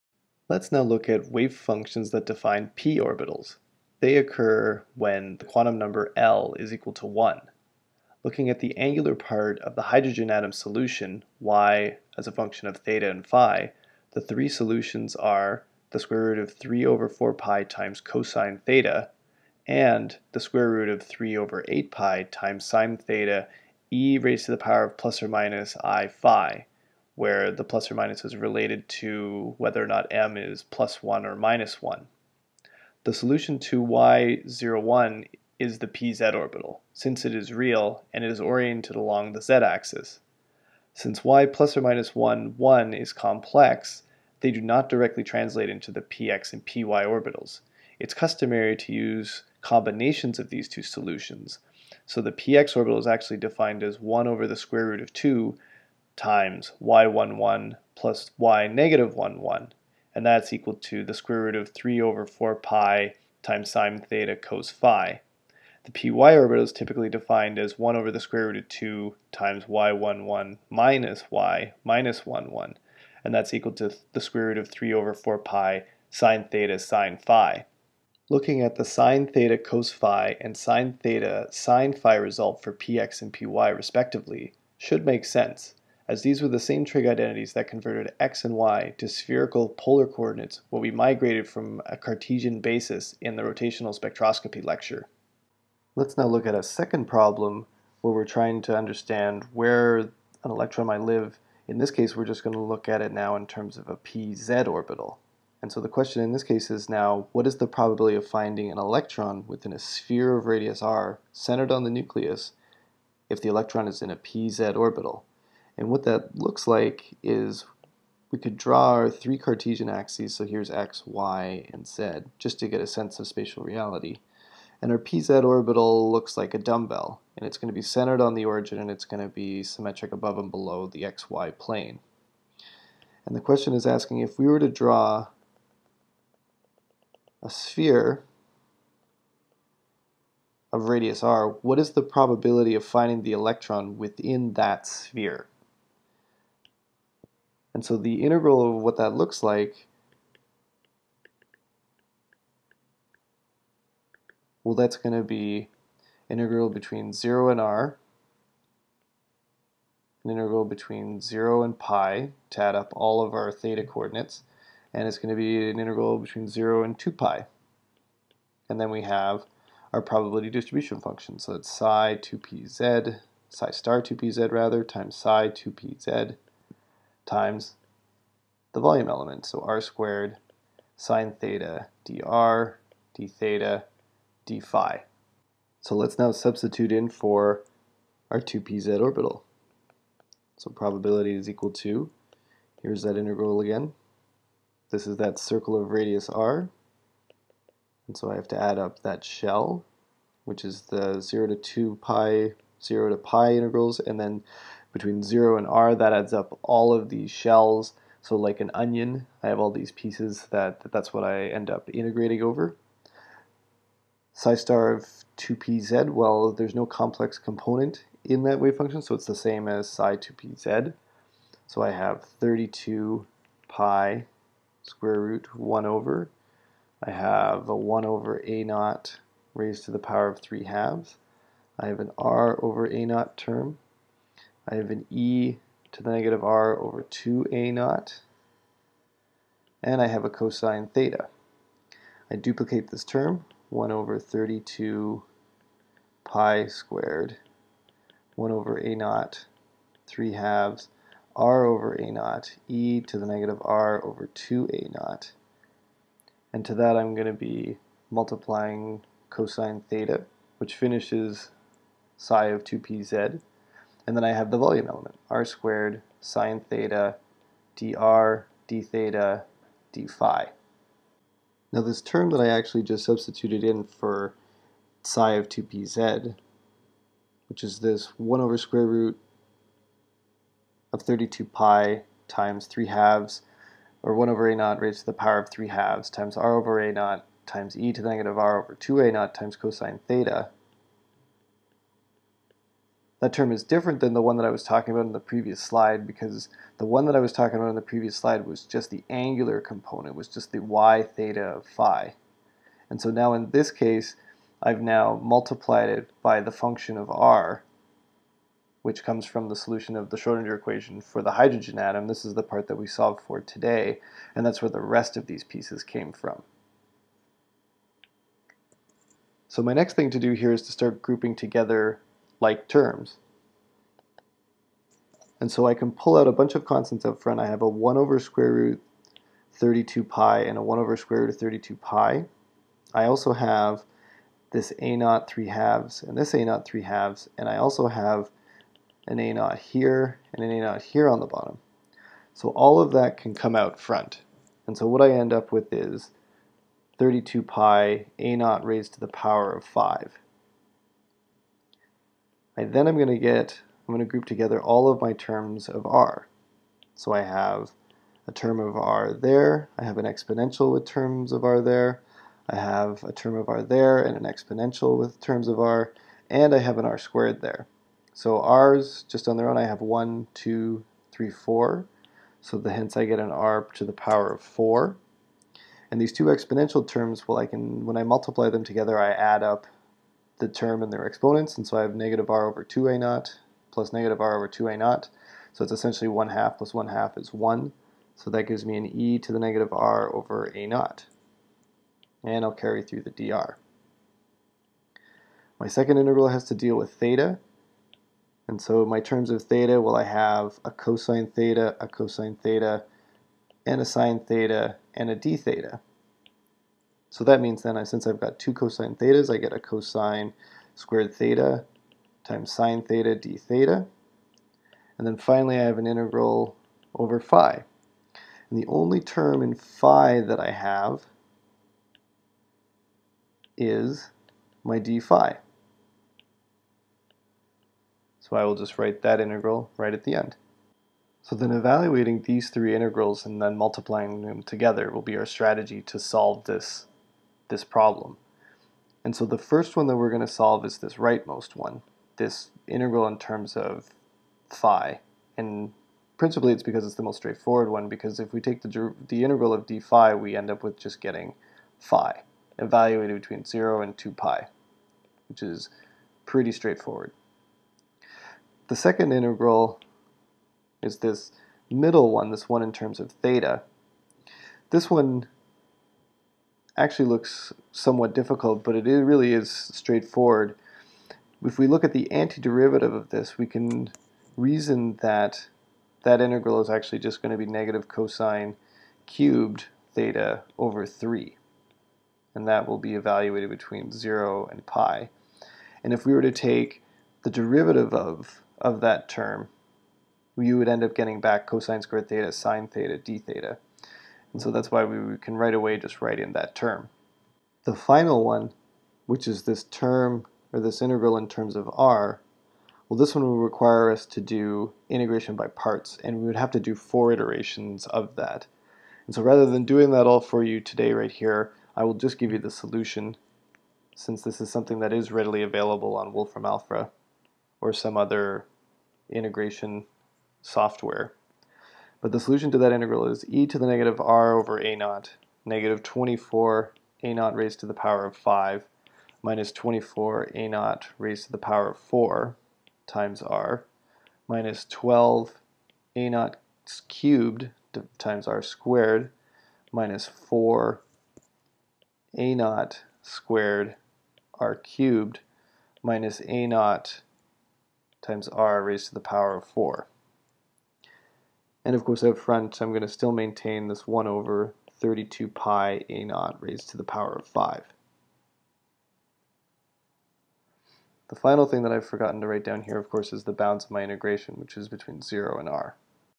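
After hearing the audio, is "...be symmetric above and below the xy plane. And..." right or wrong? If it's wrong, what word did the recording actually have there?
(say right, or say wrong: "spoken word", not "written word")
right.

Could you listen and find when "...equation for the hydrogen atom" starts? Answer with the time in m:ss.
5:10.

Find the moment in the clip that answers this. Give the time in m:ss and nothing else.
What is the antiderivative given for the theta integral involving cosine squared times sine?
7:57.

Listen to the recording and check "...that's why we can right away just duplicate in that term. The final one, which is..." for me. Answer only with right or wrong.
wrong.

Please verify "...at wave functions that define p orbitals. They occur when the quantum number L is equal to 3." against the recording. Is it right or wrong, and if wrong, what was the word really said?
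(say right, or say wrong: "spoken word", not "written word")
wrong: "1", not "3".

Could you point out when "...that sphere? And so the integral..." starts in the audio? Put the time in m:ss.
2:24.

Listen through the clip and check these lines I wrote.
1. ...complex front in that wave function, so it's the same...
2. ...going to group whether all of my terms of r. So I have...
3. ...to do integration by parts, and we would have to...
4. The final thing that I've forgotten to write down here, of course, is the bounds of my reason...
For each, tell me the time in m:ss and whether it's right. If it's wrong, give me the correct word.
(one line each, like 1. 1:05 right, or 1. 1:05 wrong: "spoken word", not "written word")
1. 3:36 wrong: "component", not "front"
2. 5:53 wrong: "together", not "whether"
3. 8:24 right
4. 9:21 wrong: "integration", not "reason".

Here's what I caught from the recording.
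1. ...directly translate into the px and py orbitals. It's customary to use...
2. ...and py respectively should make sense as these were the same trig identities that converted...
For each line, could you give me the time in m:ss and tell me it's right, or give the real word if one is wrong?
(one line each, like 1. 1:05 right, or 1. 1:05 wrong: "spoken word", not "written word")
1. 0:44 right
2. 1:23 right.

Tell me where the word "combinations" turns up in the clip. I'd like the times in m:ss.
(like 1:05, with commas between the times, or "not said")
0:49.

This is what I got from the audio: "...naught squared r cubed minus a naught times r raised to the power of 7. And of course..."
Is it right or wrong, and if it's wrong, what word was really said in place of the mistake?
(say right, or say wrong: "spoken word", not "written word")
wrong: "4", not "7".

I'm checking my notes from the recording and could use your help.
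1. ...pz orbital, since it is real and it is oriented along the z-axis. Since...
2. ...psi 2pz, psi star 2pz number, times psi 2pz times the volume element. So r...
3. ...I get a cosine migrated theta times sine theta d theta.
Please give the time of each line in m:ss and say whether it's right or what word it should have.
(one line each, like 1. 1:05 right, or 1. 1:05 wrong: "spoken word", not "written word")
1. 0:35 right
2. 2:51 wrong: "rather", not "number"
3. 6:49 wrong: "squared", not "migrated".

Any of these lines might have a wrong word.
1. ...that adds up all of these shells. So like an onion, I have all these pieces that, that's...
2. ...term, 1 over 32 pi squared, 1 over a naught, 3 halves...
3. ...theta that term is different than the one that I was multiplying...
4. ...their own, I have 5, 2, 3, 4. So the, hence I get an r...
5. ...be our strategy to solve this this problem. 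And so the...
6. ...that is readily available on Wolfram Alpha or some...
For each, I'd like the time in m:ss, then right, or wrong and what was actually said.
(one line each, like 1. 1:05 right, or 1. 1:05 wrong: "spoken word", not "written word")
1. 3:25 right
2. 4:03 right
3. 4:50 wrong: "talking", not "multiplying"
4. 6:09 wrong: "1", not "5"
5. 7:15 right
6. 8:34 right.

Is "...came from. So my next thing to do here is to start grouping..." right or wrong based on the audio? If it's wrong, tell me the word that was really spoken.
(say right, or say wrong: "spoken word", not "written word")
right.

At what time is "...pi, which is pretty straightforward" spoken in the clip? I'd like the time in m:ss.
7:34.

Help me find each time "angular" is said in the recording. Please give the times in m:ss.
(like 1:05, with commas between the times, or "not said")
0:08, 4:59.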